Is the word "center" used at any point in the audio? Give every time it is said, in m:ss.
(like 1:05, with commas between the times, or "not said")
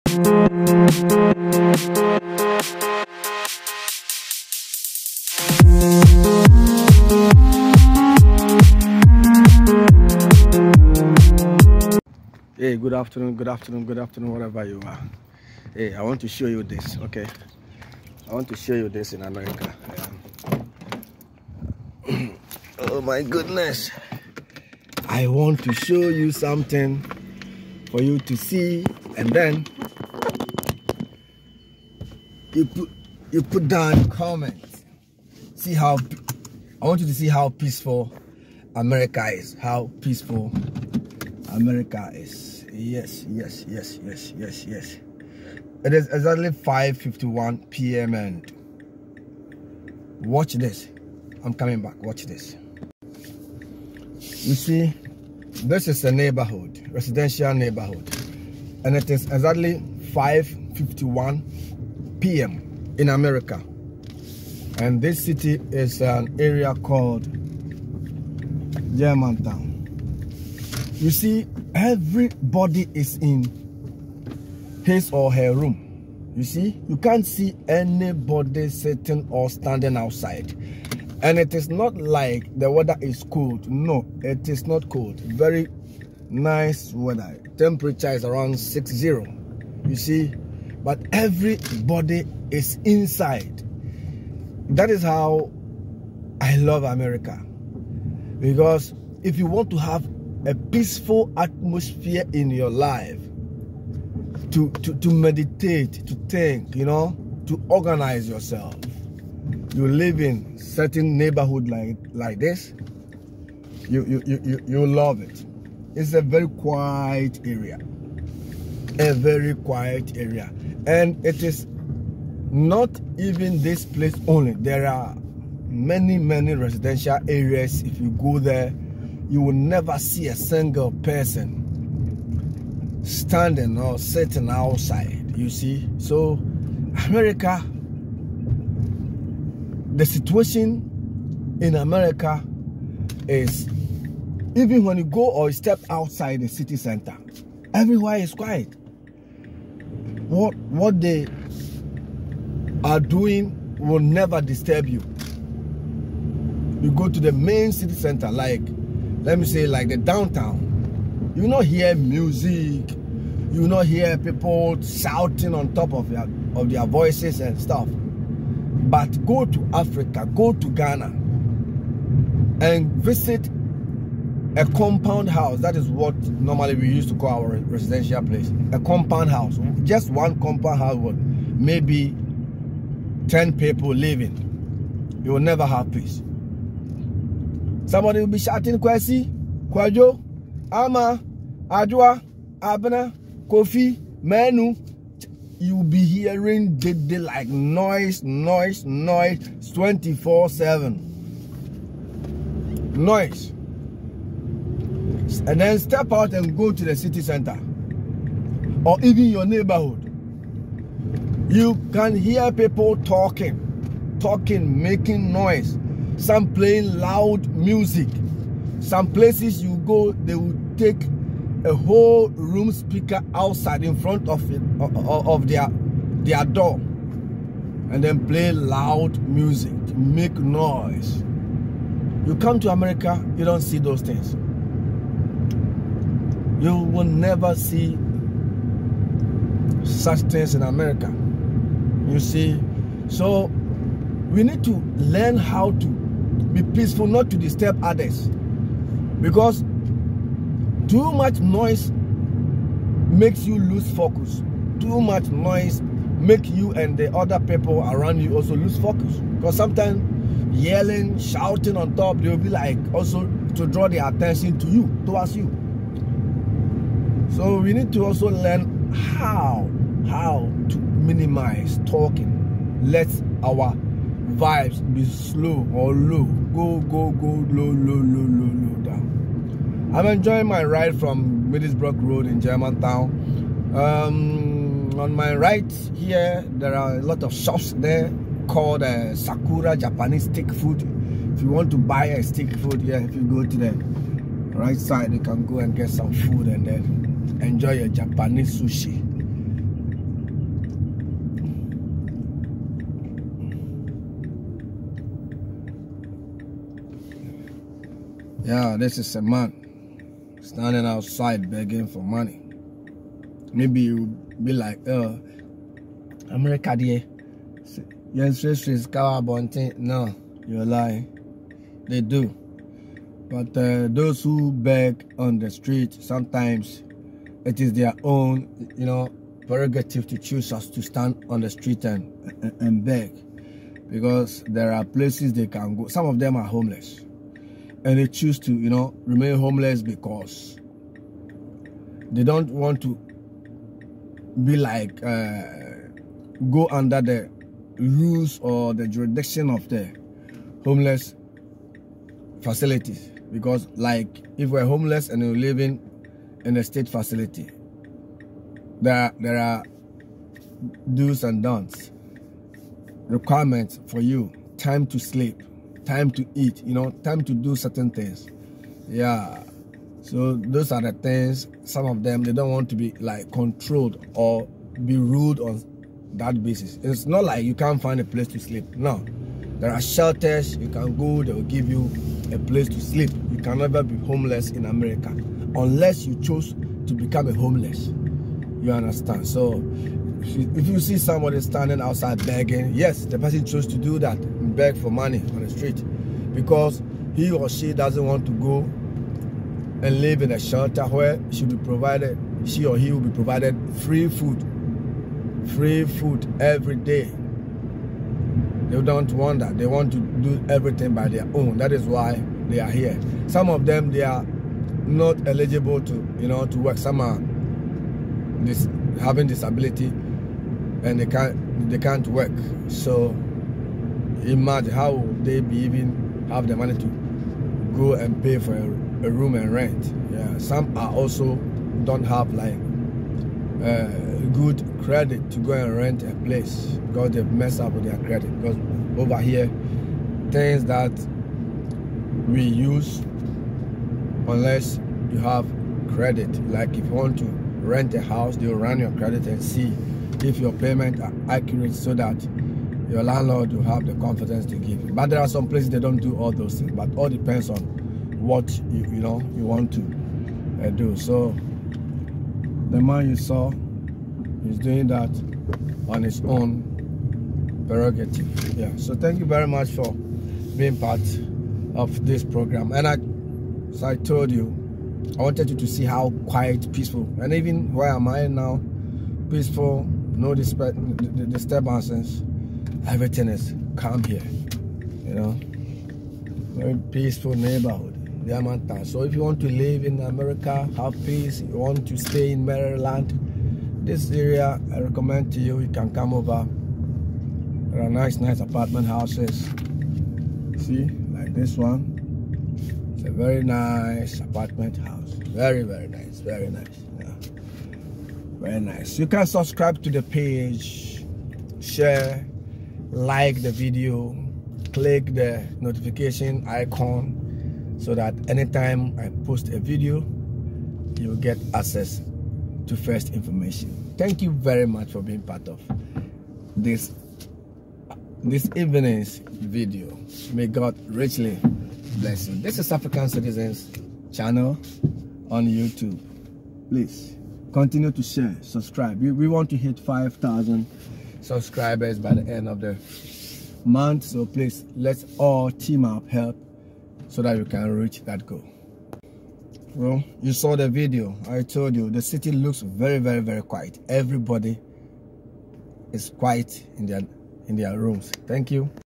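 2:26, 2:37, 3:27.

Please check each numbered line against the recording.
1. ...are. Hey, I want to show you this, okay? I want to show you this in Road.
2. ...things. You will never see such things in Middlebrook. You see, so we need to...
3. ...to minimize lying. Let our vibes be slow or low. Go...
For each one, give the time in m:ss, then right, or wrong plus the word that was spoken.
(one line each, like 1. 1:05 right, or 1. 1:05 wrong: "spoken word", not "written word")
1. 0:14 wrong: "America", not "Road"
2. 3:54 wrong: "America", not "Middlebrook"
3. 4:30 wrong: "talking", not "lying".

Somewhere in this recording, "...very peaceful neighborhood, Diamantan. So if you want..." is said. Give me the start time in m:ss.
8:06.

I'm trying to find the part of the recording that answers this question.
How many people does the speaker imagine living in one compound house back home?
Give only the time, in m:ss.
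3:03.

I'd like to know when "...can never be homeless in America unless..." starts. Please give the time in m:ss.
6:23.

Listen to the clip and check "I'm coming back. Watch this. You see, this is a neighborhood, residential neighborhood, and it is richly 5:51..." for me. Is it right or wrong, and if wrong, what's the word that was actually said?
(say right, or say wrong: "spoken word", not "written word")
wrong: "exactly", not "richly".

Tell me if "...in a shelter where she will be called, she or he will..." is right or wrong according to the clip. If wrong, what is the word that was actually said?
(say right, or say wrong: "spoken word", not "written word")
wrong: "provided", not "called".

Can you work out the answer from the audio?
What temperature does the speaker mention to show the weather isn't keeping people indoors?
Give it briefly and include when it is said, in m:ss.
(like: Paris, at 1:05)
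60, at 1:28.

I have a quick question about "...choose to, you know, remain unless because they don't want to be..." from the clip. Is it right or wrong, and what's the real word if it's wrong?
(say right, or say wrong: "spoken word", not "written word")
wrong: "homeless", not "unless".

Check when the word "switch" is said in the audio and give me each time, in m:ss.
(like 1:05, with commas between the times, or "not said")
not said.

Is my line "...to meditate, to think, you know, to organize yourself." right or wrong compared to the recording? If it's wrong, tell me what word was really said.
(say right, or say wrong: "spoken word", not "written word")
right.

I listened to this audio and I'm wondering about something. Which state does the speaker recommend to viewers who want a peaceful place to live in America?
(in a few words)
Maryland.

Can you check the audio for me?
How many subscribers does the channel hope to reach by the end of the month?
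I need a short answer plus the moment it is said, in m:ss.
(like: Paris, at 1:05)
5,000, at 8:59.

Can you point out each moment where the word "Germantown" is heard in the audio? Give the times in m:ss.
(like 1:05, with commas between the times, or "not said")
1:08, 4:42.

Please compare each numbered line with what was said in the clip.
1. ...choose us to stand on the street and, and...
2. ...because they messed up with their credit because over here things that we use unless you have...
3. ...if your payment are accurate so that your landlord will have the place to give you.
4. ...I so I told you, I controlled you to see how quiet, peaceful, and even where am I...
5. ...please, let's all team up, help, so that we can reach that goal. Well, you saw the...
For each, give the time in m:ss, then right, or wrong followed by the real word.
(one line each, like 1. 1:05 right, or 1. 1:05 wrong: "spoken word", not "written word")
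1. 5:30 right
2. 7:16 right
3. 7:30 wrong: "confidence", not "place"
4. 7:52 wrong: "wanted", not "controlled"
5. 9:04 right.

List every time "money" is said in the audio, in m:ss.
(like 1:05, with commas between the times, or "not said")
5:12, 6:34, 7:06.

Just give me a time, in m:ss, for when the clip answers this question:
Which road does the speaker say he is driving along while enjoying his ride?
4:41.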